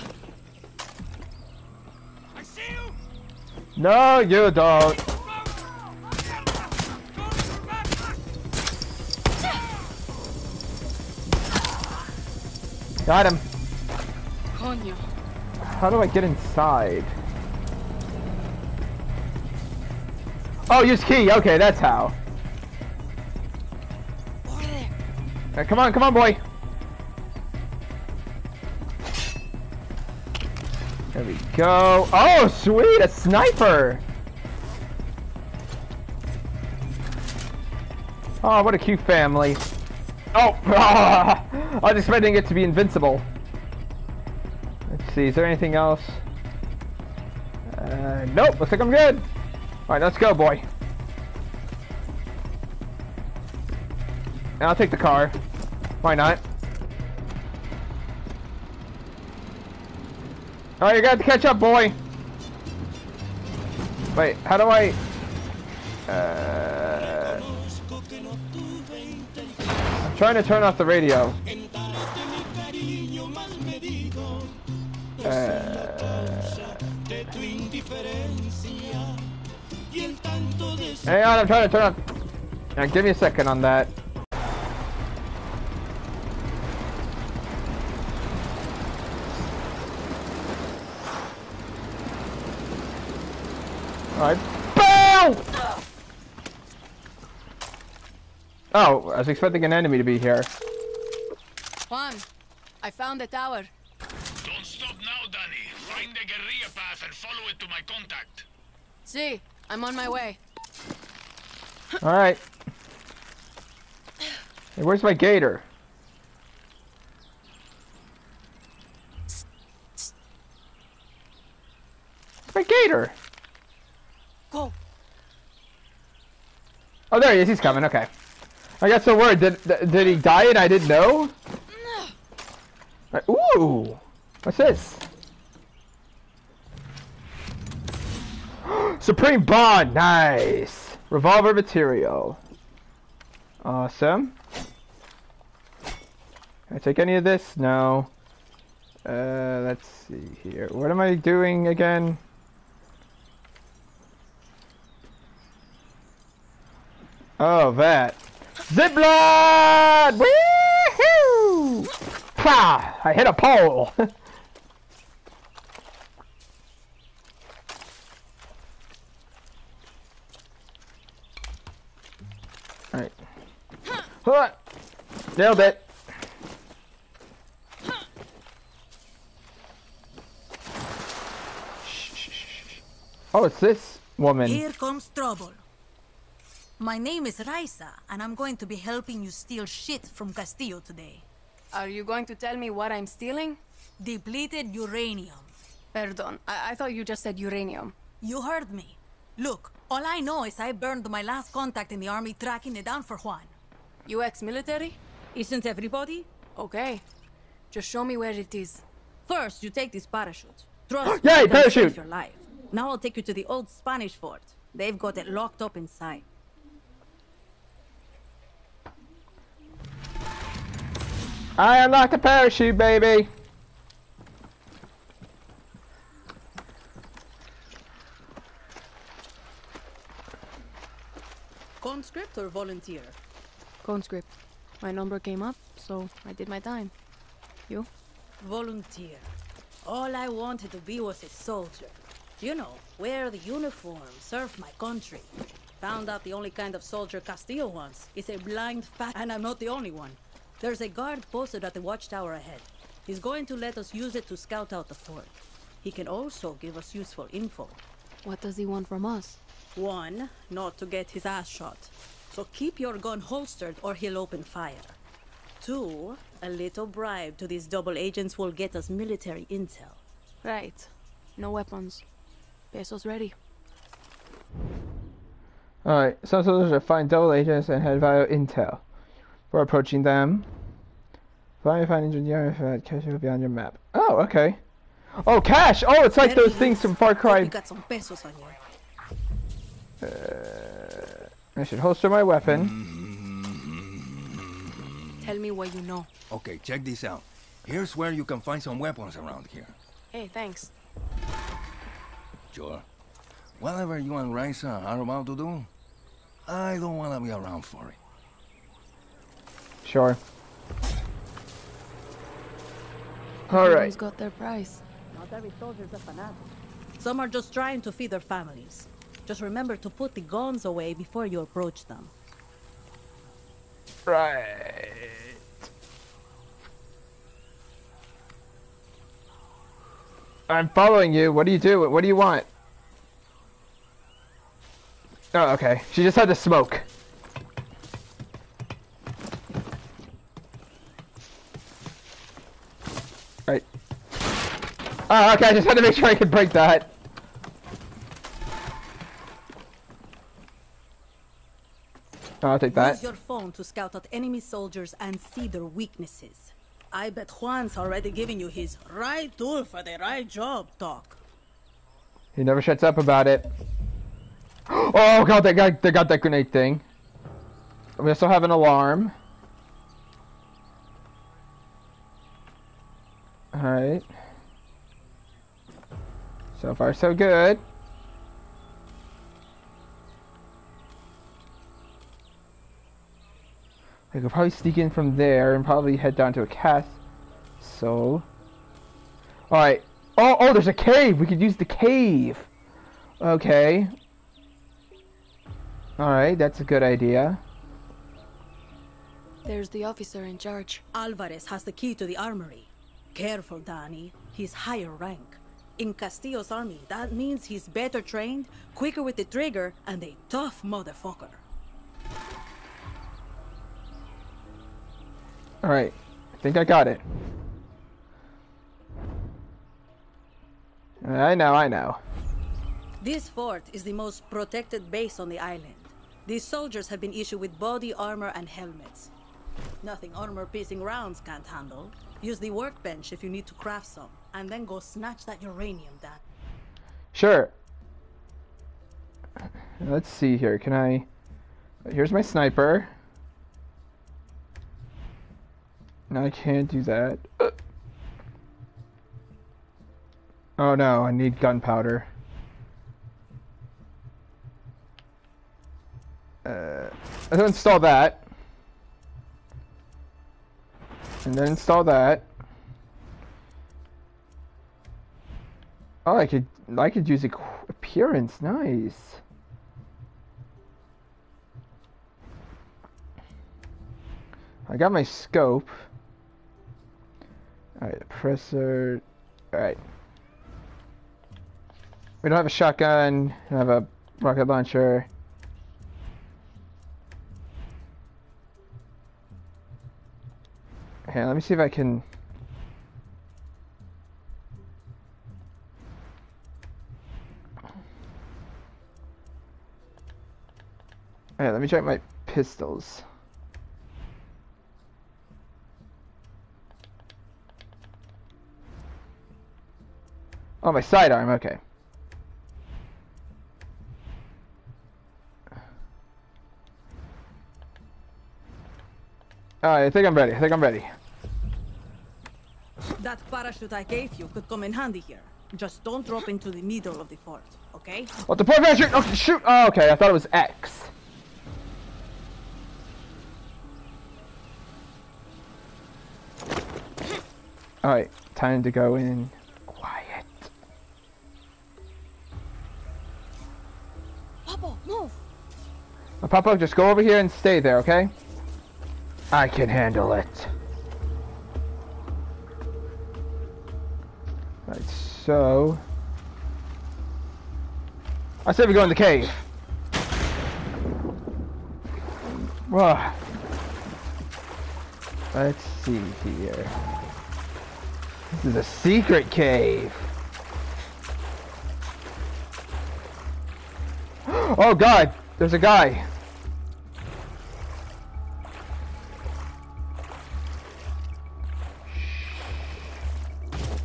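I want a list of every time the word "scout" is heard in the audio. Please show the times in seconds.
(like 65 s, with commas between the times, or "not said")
254 s, 353 s.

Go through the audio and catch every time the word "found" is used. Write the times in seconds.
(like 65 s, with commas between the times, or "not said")
102 s, 245 s.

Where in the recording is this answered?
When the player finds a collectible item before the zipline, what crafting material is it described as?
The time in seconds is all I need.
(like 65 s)
141 s.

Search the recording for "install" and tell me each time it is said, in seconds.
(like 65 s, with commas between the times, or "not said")
457 s, 461 s.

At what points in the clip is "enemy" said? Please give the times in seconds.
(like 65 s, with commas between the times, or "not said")
99 s, 354 s.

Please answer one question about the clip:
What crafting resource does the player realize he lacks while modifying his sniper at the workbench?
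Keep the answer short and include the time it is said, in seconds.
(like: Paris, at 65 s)
Gunpowder, at 451 s.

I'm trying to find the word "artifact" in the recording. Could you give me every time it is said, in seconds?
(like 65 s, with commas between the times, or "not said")
282 s.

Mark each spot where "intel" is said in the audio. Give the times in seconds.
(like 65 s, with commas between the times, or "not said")
269 s, 278 s.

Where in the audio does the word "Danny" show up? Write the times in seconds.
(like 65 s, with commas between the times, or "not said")
403 s.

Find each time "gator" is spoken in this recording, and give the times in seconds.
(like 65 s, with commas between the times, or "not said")
115 s, 122 s.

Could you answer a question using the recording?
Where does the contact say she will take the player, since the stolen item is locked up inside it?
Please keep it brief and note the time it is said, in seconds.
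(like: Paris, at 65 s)
Old Spanish fort, at 213 s.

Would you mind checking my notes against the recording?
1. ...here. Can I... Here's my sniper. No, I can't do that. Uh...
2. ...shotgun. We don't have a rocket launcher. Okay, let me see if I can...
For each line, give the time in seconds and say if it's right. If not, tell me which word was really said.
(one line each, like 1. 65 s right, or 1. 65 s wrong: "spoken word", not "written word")
1. 440 s right
2. 482 s right.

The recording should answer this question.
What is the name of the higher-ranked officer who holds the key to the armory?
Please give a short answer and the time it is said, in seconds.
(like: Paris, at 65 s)
Alvarez, at 400 s.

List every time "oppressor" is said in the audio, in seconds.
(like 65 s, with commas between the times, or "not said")
478 s.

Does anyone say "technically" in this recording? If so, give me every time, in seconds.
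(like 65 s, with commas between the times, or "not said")
not said.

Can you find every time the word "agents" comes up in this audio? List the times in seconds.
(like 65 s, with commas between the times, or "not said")
267 s, 277 s.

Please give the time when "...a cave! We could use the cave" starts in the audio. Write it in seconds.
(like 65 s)
390 s.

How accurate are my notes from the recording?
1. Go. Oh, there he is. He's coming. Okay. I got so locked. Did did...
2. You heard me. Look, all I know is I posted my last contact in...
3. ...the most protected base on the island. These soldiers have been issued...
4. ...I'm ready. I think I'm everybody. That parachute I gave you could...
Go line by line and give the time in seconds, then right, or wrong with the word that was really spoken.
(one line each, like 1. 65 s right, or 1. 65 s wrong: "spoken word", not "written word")
1. 124 s wrong: "worried", not "locked"
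2. 198 s wrong: "burned", not "posted"
3. 423 s right
4. 520 s wrong: "ready", not "everybody".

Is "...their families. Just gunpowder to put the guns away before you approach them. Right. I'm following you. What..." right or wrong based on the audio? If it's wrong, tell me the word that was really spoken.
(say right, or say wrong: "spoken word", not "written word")
wrong: "remember", not "gunpowder".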